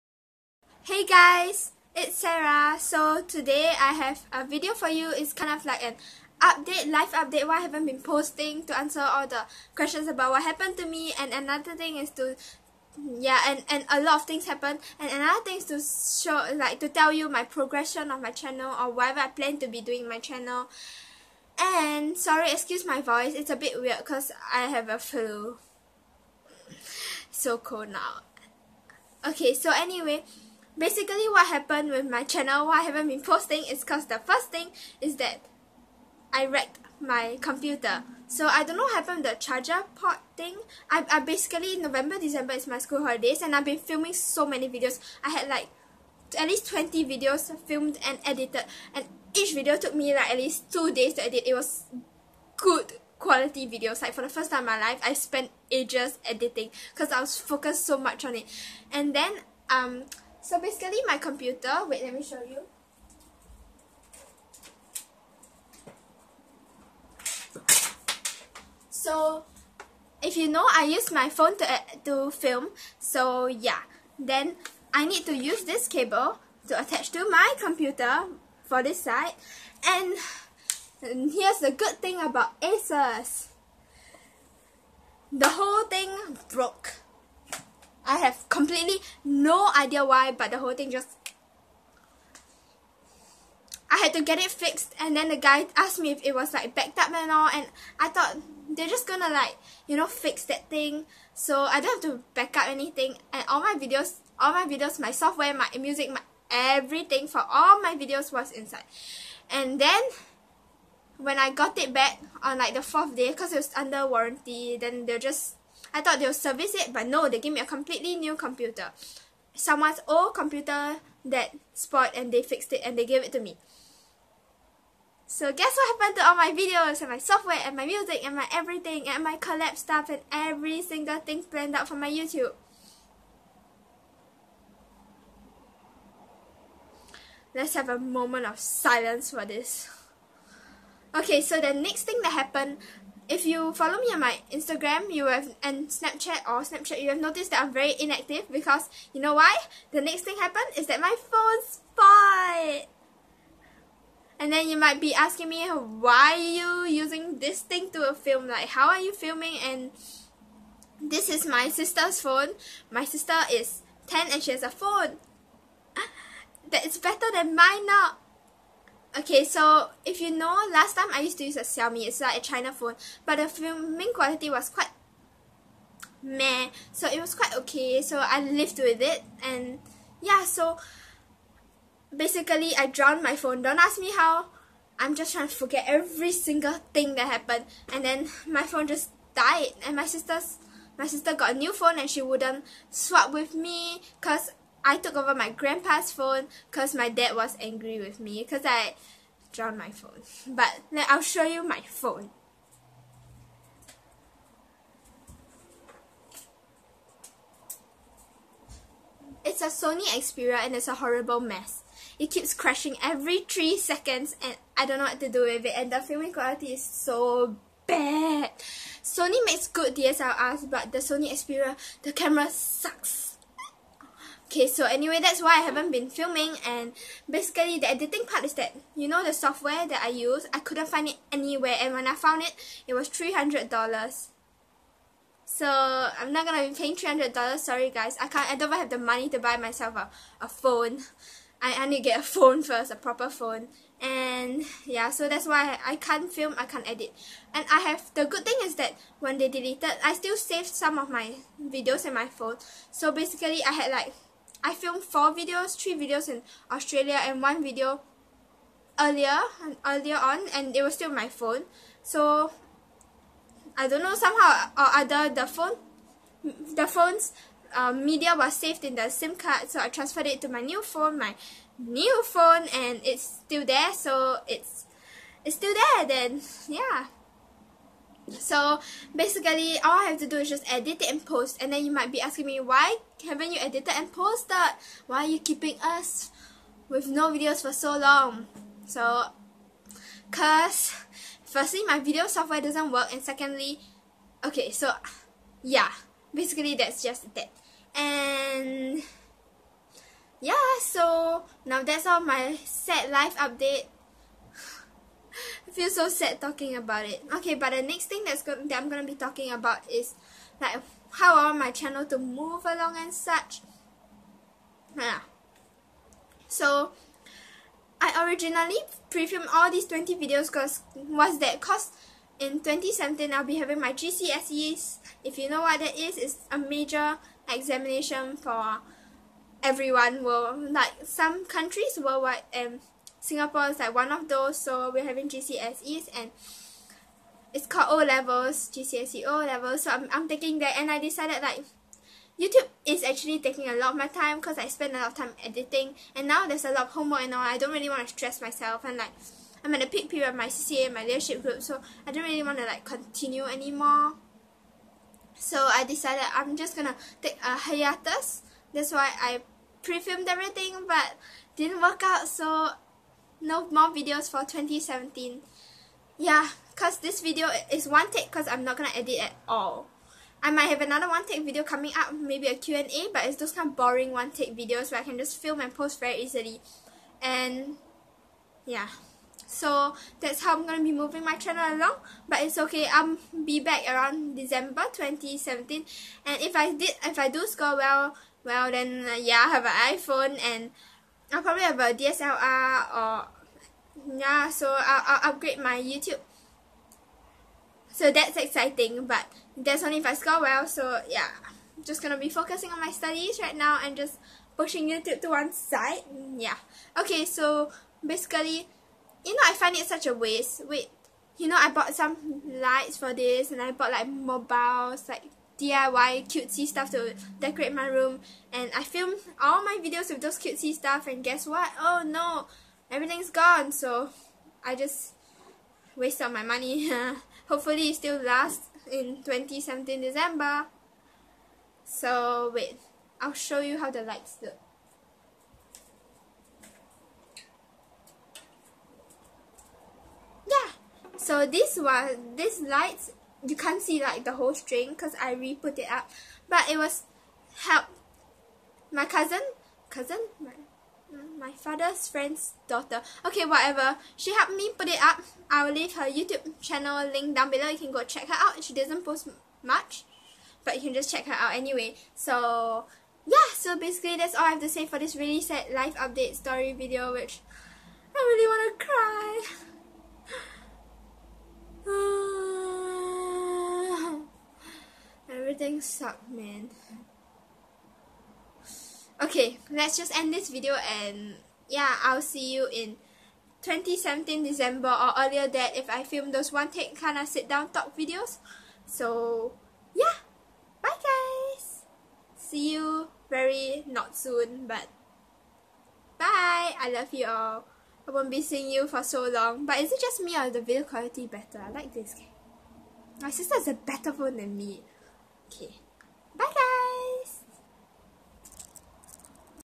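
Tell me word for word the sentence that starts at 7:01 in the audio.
Oh no, everything's gone so I just wasted my money.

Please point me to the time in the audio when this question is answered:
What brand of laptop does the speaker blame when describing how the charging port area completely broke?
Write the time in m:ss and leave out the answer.
1:22.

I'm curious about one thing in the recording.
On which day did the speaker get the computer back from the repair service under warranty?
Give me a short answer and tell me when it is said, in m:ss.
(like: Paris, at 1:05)
fourth day, at 1:52.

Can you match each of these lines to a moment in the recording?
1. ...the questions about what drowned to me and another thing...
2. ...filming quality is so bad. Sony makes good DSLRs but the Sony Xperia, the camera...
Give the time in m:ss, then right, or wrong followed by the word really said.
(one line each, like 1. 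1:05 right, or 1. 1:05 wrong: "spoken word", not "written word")
1. 0:09 wrong: "happened", not "drowned"
2. 3:35 right.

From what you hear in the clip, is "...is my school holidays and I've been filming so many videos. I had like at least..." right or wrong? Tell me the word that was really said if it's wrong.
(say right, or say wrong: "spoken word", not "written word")
right.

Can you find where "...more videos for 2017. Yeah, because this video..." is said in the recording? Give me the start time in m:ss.
6:03.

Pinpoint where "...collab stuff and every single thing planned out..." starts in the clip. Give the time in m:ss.
2:09.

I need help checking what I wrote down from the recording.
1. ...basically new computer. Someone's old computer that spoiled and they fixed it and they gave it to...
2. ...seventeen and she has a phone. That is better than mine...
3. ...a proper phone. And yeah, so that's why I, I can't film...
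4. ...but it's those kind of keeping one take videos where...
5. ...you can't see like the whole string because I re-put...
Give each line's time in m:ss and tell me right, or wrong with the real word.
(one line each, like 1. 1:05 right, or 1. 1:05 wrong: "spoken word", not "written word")
1. 1:57 wrong: "completely", not "basically"
2. 2:44 wrong: "ten", not "seventeen"
3. 4:02 right
4. 6:13 wrong: "boring", not "keeping"
5. 7:23 right.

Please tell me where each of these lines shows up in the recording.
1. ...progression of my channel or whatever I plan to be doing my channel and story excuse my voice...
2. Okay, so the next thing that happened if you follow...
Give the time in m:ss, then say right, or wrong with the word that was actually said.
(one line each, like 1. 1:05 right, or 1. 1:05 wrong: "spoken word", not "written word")
1. 0:17 wrong: "sorry", not "story"
2. 2:21 right.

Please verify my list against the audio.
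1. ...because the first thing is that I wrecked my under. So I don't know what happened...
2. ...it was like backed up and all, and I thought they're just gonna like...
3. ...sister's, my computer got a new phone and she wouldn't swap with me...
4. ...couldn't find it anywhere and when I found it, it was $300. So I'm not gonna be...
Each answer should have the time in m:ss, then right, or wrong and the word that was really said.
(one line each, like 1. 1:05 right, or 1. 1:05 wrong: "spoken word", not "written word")
1. 0:33 wrong: "computer", not "under"
2. 1:36 right
3. 3:10 wrong: "sister", not "computer"
4. 3:50 right.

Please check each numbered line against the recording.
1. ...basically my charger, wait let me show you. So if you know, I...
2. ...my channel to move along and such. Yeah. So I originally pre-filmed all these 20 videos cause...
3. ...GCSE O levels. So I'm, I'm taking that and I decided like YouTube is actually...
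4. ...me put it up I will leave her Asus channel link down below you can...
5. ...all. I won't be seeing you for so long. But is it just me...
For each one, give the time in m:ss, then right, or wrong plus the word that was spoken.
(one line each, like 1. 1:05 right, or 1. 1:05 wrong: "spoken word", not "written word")
1. 1:00 wrong: "computer", not "charger"
2. 5:11 right
3. 5:38 right
4. 7:34 wrong: "YouTube", not "Asus"
5. 8:17 right.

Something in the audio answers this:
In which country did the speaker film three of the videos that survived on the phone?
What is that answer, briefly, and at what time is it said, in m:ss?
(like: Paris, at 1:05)
Australia, at 4:16.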